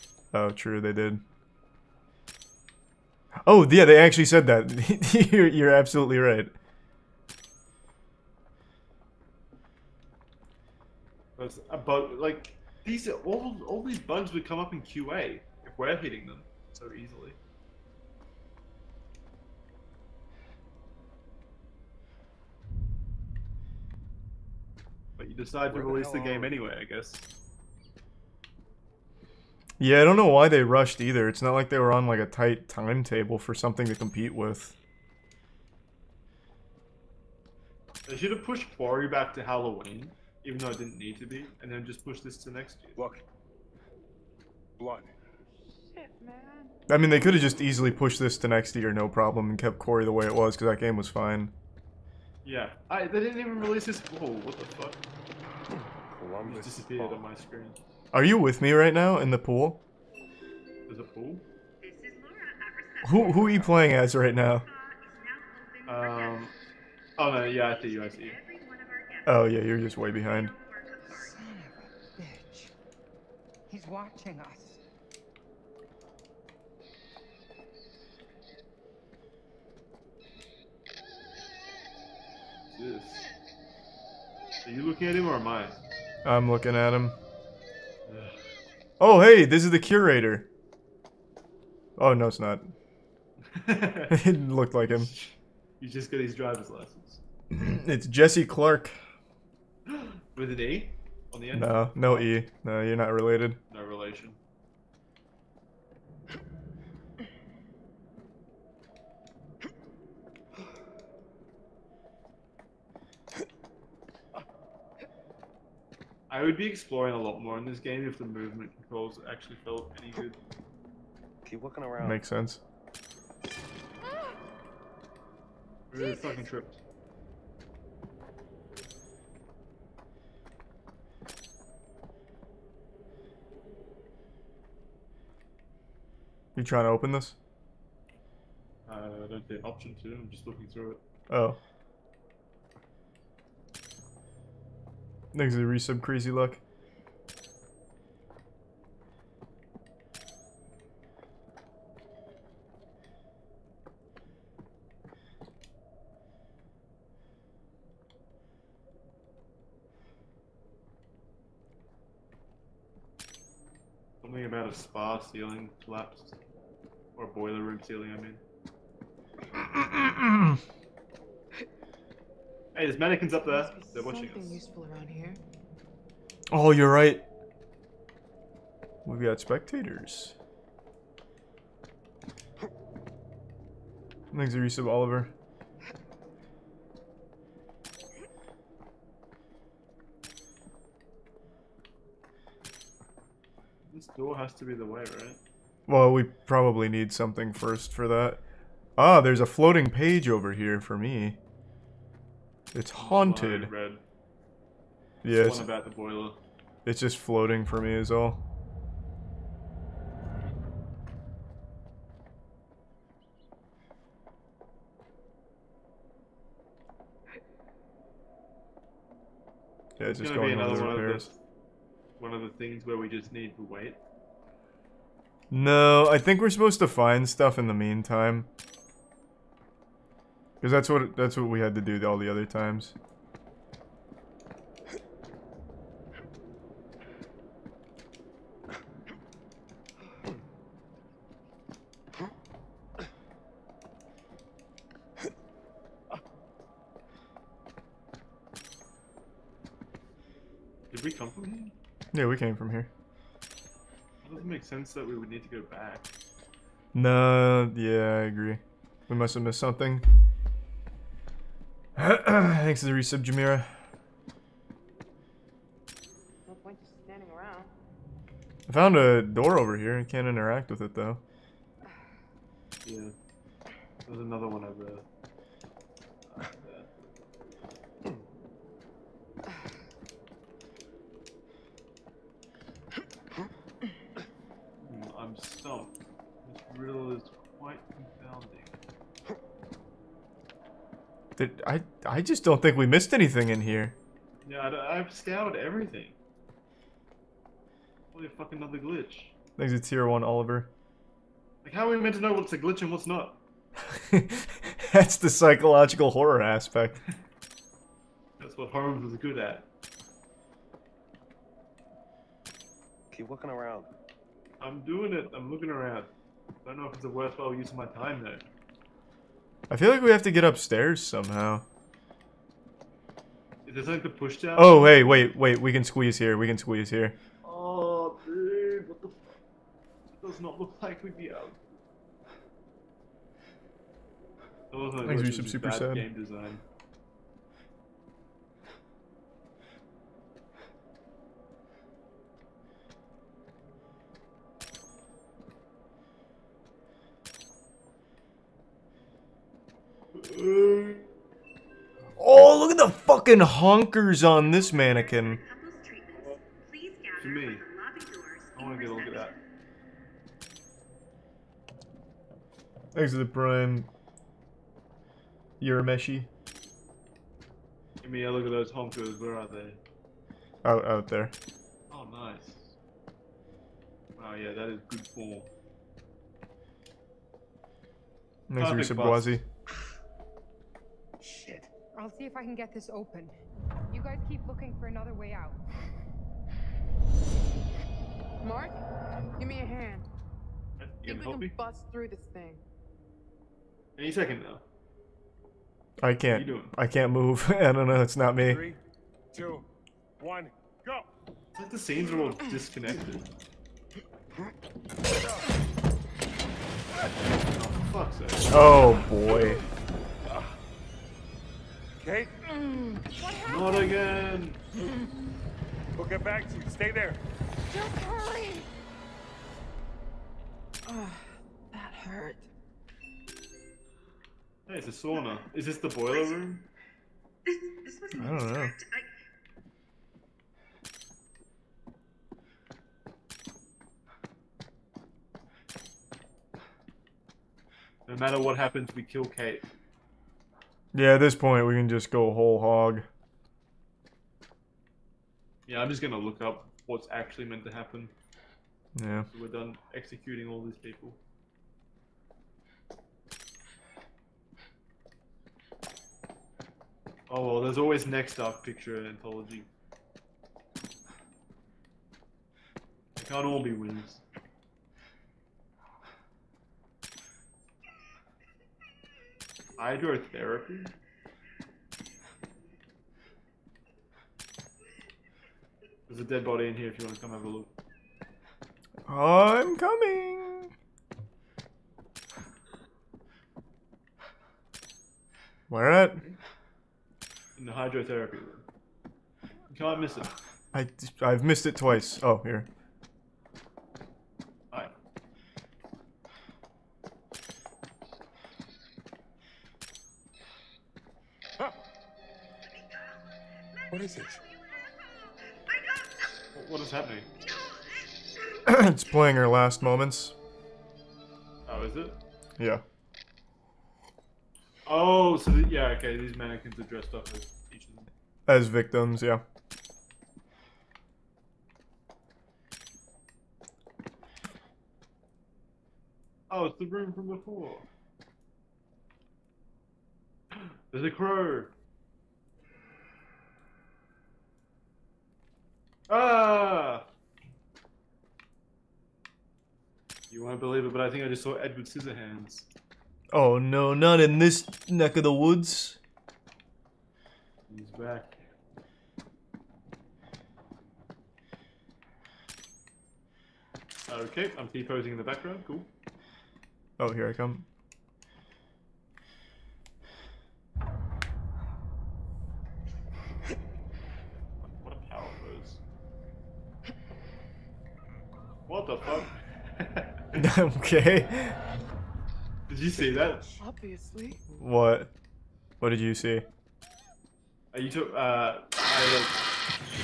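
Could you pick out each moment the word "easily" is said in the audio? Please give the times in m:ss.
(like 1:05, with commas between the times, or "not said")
0:16, 0:47.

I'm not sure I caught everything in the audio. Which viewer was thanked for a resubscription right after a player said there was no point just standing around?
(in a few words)
Jamira.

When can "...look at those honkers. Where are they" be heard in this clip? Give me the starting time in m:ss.
6:08.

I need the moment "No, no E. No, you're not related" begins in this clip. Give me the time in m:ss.
1:41.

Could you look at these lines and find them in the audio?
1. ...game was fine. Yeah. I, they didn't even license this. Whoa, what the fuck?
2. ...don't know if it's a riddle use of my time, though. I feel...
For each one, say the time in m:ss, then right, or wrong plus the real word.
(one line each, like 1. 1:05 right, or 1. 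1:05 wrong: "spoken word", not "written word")
1. 0:50 wrong: "release", not "license"
2. 5:16 wrong: "worthwhile", not "riddle".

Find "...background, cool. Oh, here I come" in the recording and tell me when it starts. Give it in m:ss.
9:15.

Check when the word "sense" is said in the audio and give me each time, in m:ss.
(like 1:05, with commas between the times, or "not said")
2:02, 4:14.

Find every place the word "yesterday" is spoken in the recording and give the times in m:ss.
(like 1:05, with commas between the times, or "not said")
not said.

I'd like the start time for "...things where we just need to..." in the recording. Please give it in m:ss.
3:42.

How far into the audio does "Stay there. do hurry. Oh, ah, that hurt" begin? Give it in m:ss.
6:56.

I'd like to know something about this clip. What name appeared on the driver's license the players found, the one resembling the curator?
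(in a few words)
Jesse Clark.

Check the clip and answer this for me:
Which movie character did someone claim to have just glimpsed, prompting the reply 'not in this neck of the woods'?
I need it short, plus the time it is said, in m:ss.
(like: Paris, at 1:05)
Edward Scissorhands, at 9:01.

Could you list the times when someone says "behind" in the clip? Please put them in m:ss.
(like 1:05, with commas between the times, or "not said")
1:10.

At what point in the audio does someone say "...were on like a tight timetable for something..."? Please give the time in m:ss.
0:31.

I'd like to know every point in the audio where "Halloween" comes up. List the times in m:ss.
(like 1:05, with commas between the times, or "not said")
0:39.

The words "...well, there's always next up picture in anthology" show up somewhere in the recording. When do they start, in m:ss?
7:37.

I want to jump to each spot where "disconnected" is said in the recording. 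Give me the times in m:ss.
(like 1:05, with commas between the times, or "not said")
6:42.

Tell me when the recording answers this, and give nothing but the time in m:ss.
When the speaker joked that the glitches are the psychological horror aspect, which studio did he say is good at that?
5:08.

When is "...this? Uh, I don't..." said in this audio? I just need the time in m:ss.
2:17.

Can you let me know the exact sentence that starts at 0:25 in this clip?
But you decide to release the, the game anyway, I guess.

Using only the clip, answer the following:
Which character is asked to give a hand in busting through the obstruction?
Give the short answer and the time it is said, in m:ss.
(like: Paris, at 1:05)
Mark, at 6:28.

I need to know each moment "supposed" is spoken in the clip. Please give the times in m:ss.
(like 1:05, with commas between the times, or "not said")
3:46.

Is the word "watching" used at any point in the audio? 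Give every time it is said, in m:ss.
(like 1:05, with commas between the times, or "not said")
1:13, 2:54.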